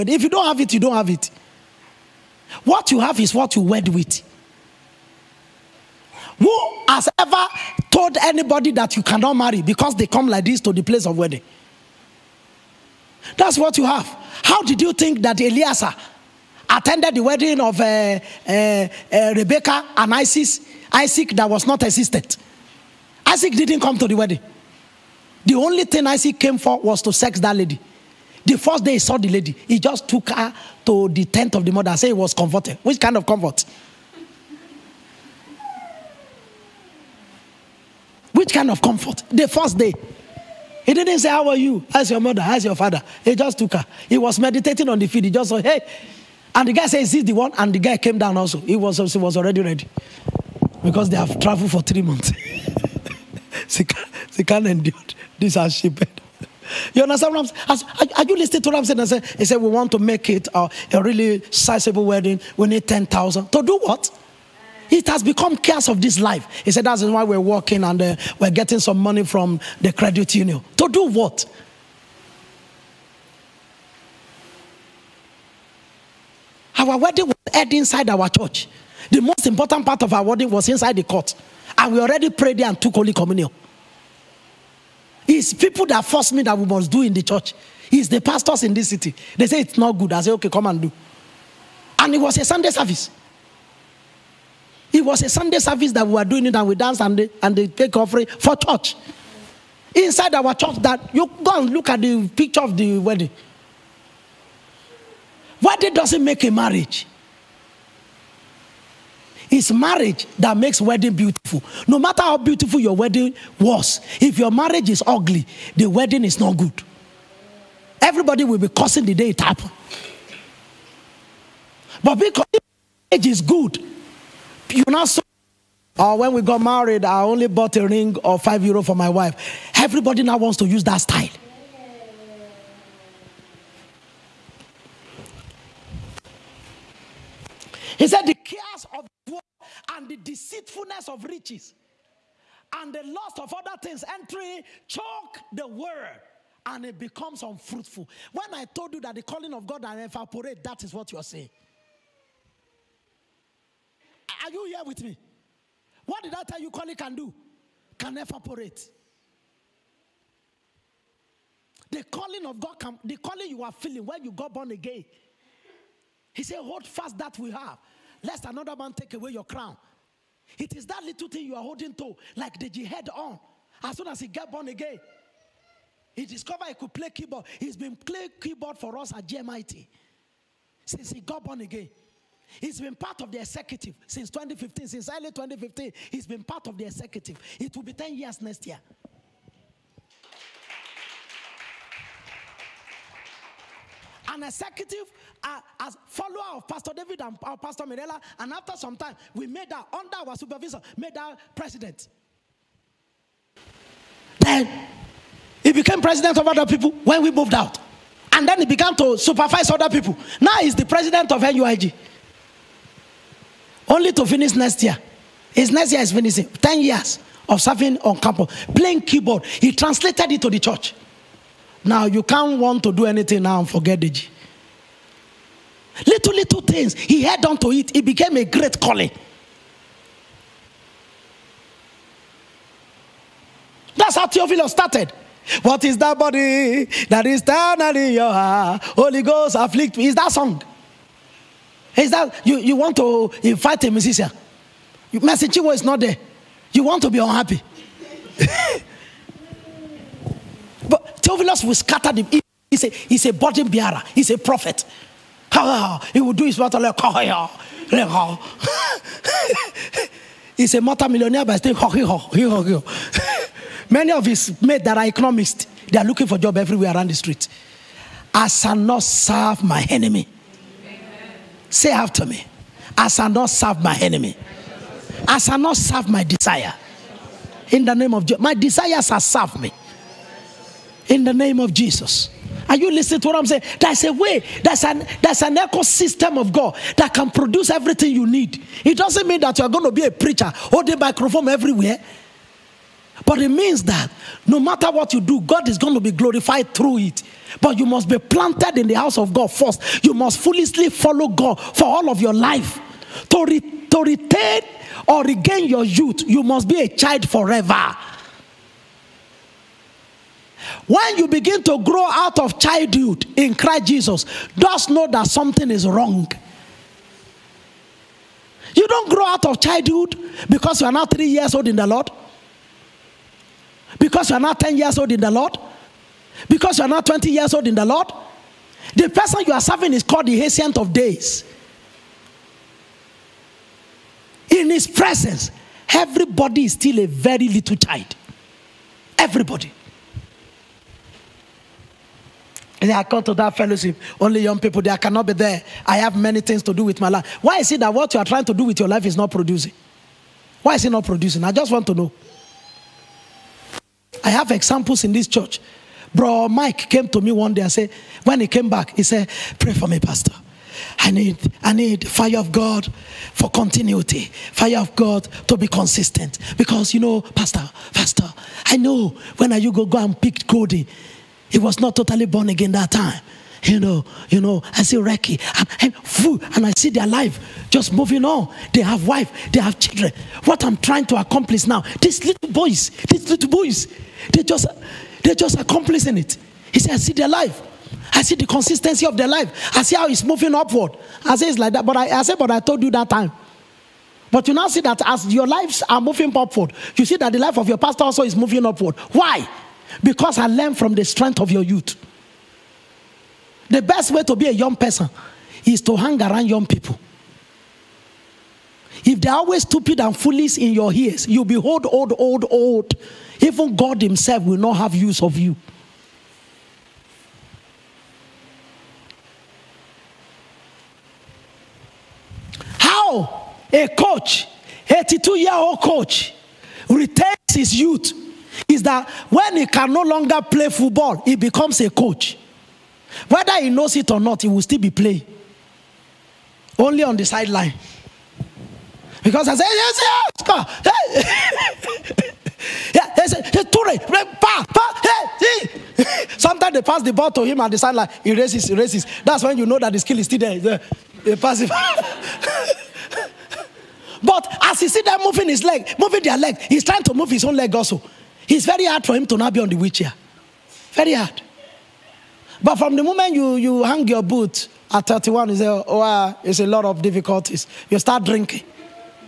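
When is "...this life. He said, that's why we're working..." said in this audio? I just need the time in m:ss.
1:06.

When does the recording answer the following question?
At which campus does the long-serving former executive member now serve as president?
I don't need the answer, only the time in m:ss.
3:31.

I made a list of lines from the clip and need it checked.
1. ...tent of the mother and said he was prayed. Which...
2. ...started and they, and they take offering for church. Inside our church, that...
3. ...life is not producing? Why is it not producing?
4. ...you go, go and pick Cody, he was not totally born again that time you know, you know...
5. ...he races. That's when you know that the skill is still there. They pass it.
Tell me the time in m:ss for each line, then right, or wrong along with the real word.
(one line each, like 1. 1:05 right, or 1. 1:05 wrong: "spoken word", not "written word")
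1. 0:31 wrong: "converted", not "prayed"
2. 1:36 wrong: "danced", not "started"
3. 5:48 right
4. 6:09 right
5. 7:28 right.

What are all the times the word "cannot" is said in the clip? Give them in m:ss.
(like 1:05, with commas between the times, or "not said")
0:09, 5:44.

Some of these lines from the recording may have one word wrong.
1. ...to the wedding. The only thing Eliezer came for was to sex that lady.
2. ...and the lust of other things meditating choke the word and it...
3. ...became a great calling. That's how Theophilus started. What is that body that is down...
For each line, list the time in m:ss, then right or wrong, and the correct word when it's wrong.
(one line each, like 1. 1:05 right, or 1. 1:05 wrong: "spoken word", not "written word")
1. 0:23 wrong: "Isaac", not "Eliezer"
2. 2:22 wrong: "entering", not "meditating"
3. 3:48 right.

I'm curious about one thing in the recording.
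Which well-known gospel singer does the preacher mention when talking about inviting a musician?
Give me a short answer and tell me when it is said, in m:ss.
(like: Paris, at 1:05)
Mercy Chinwo, at 4:05.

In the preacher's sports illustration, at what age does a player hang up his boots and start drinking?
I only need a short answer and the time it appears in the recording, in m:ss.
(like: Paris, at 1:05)
31, at 7:45.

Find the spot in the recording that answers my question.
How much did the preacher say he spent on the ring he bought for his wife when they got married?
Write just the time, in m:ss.
2:08.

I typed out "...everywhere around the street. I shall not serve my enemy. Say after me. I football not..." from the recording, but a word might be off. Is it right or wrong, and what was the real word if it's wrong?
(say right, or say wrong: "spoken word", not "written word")
wrong: "shall", not "football".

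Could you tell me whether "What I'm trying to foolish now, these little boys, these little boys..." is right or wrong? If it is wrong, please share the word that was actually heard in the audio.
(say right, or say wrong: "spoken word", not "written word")
wrong: "accomplish", not "foolish".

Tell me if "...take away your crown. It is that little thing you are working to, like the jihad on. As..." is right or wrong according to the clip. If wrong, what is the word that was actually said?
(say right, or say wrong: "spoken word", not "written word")
wrong: "holding", not "working".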